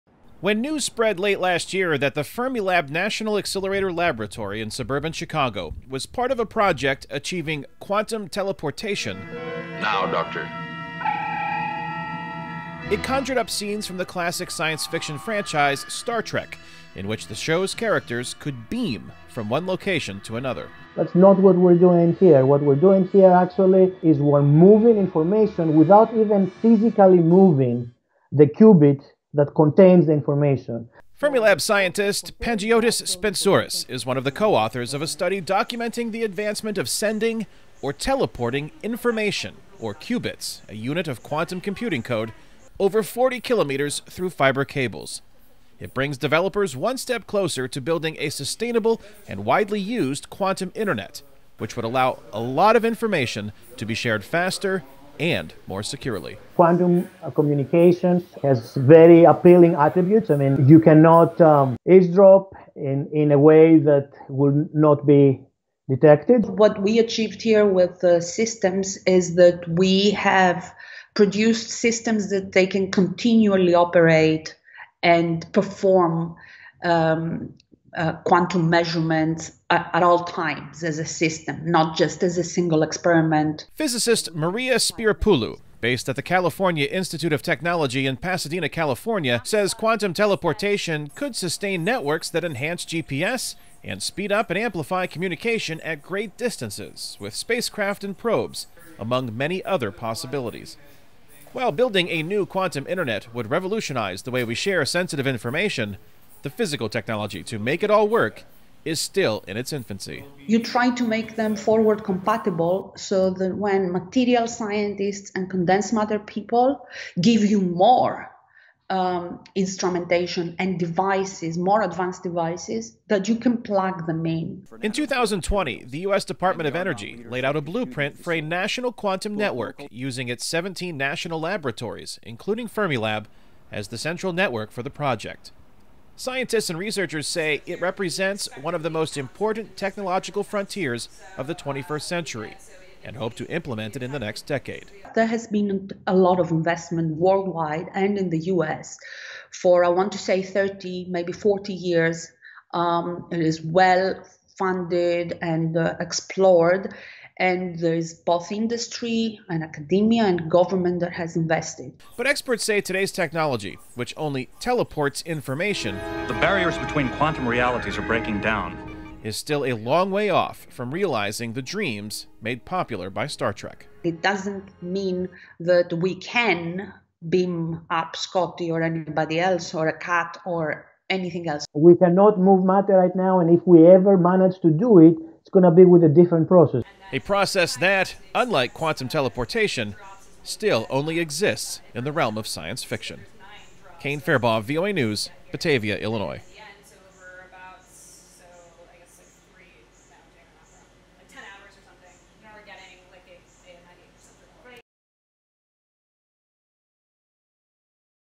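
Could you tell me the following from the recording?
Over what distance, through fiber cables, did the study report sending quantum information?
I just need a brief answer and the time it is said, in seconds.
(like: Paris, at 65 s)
40 kilometers, at 43 s.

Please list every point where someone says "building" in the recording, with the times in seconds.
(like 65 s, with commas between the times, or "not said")
47 s, 101 s.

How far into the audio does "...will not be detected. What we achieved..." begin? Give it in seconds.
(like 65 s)
64 s.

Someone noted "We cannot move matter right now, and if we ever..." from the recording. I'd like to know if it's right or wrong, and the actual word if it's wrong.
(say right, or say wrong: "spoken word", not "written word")
right.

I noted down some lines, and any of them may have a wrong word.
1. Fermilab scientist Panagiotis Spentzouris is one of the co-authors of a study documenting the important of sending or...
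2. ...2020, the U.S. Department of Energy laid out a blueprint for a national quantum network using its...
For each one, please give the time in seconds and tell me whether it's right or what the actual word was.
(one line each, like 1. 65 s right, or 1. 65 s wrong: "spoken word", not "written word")
1. 31 s wrong: "advancement", not "important"
2. 124 s right.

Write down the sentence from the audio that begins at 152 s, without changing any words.
Um, it is well funded and uh, explored and there is both industry and academia and government that has invested.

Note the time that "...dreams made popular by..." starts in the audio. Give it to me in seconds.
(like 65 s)
171 s.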